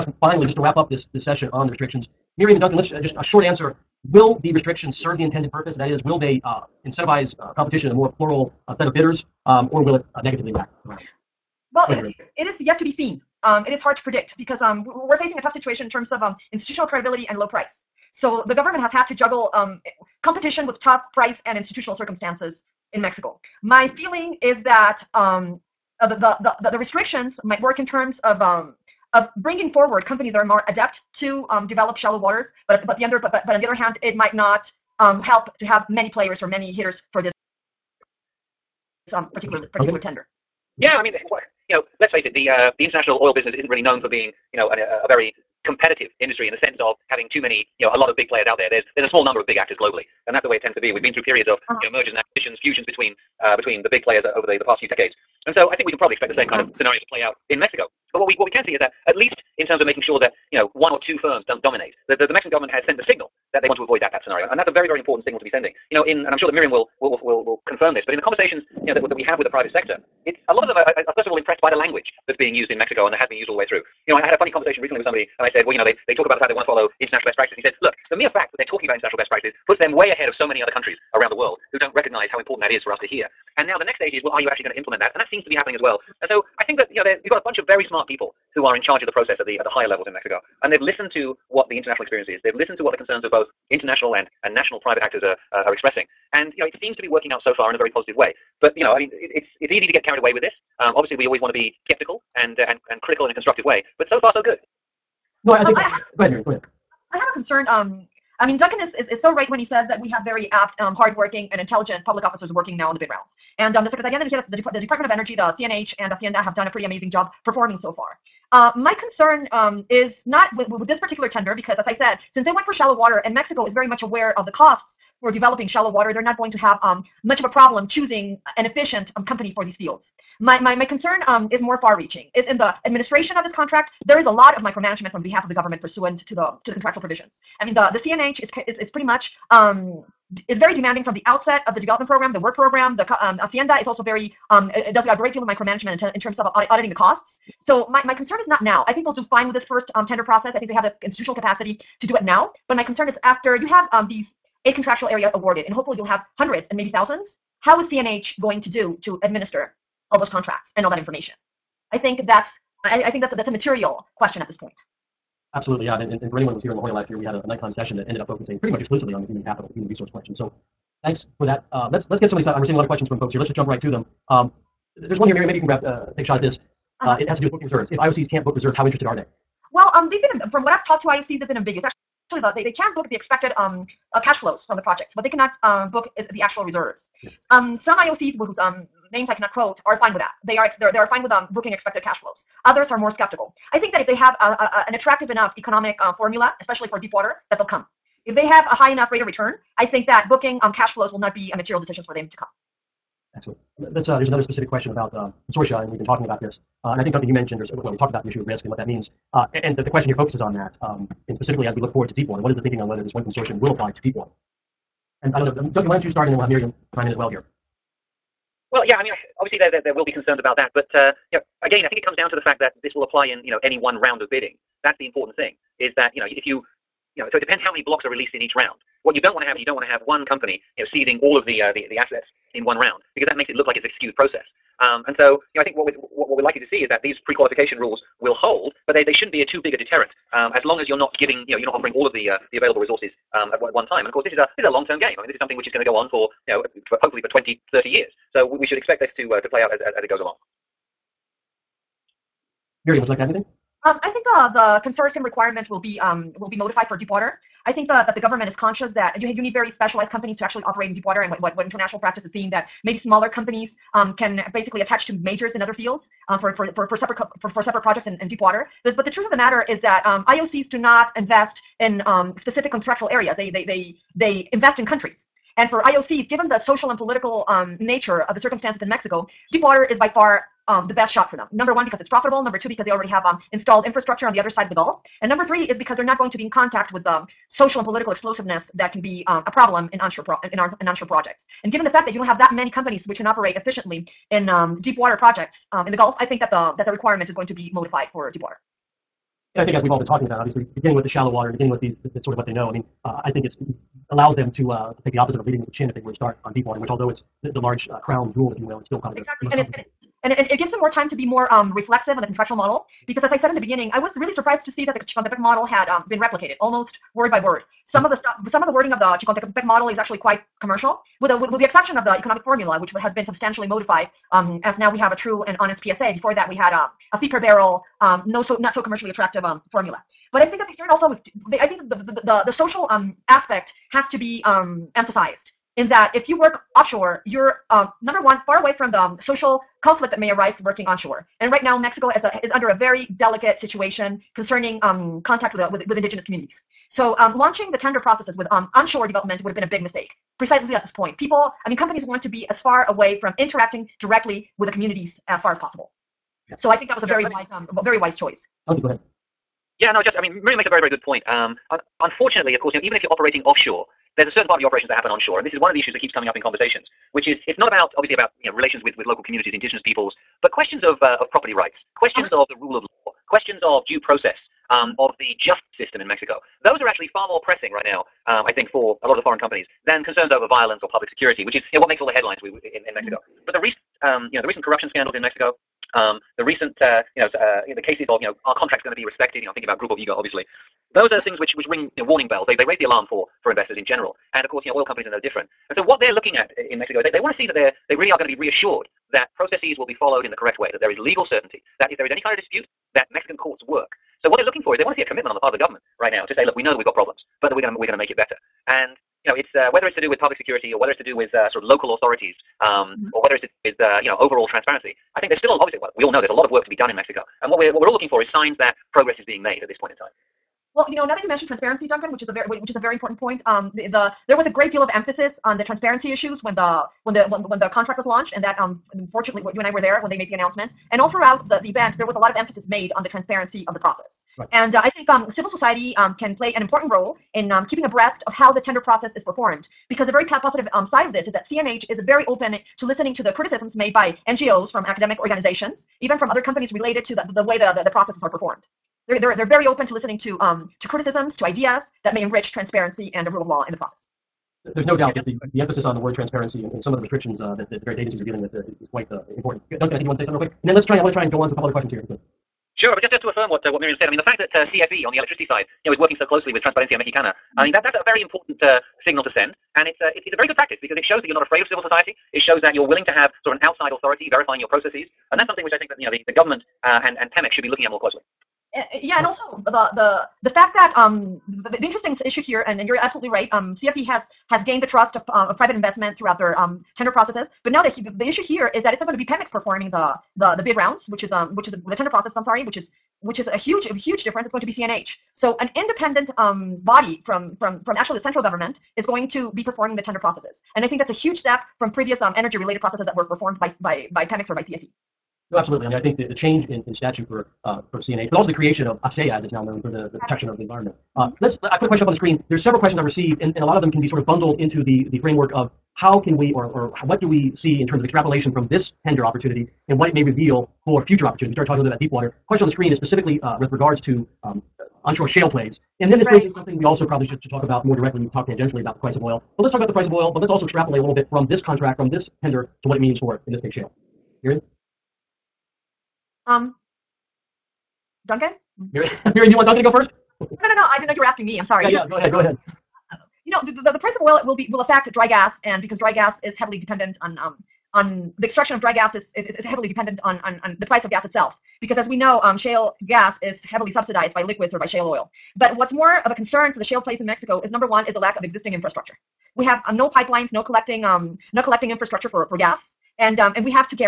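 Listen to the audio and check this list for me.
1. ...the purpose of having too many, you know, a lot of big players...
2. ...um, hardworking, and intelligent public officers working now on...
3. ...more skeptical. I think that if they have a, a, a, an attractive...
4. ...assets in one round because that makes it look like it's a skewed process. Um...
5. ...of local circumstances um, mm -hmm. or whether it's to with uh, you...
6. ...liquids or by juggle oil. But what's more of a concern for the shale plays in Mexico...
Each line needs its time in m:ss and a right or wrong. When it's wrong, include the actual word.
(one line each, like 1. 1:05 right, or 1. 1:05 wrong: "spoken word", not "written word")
1. 0:46 wrong: "sense", not "purpose"
2. 1:50 right
3. 3:12 right
4. 3:51 right
5. 6:51 wrong: "authorities", not "circumstances"
6. 9:14 wrong: "shale", not "juggle".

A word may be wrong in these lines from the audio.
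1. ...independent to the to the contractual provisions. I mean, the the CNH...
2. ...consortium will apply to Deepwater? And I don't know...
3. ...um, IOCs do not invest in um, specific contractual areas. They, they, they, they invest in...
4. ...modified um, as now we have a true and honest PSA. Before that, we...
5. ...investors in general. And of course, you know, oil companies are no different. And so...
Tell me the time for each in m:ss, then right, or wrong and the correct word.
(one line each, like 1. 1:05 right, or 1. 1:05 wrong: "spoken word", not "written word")
1. 2:15 wrong: "pursuant", not "independent"
2. 3:33 right
3. 4:30 right
4. 5:23 right
5. 6:33 right.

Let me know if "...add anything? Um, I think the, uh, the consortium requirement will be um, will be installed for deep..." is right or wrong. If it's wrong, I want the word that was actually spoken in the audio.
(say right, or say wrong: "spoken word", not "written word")
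wrong: "modified", not "installed".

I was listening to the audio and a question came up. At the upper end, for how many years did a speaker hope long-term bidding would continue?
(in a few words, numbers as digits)
30.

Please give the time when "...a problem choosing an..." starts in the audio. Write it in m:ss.
2:07.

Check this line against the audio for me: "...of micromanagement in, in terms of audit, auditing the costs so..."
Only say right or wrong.
right.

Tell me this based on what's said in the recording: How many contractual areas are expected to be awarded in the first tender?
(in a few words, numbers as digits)
8.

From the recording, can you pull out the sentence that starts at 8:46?
brings in something we also probably should, should talk about more directly.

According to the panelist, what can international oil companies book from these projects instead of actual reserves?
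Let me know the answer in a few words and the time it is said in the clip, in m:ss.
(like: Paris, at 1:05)
expected cash flows, at 3:03.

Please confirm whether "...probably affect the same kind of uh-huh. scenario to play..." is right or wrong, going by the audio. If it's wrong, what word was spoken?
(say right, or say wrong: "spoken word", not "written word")
wrong: "expect", not "affect".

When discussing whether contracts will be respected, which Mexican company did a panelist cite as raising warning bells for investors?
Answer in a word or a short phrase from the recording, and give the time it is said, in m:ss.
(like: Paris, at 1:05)
Grupo Higa, at 6:29.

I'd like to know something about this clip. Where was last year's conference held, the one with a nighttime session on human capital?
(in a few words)
La Jolla.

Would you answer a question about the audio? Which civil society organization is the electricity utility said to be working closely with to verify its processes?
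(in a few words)
Transparencia Mexicana.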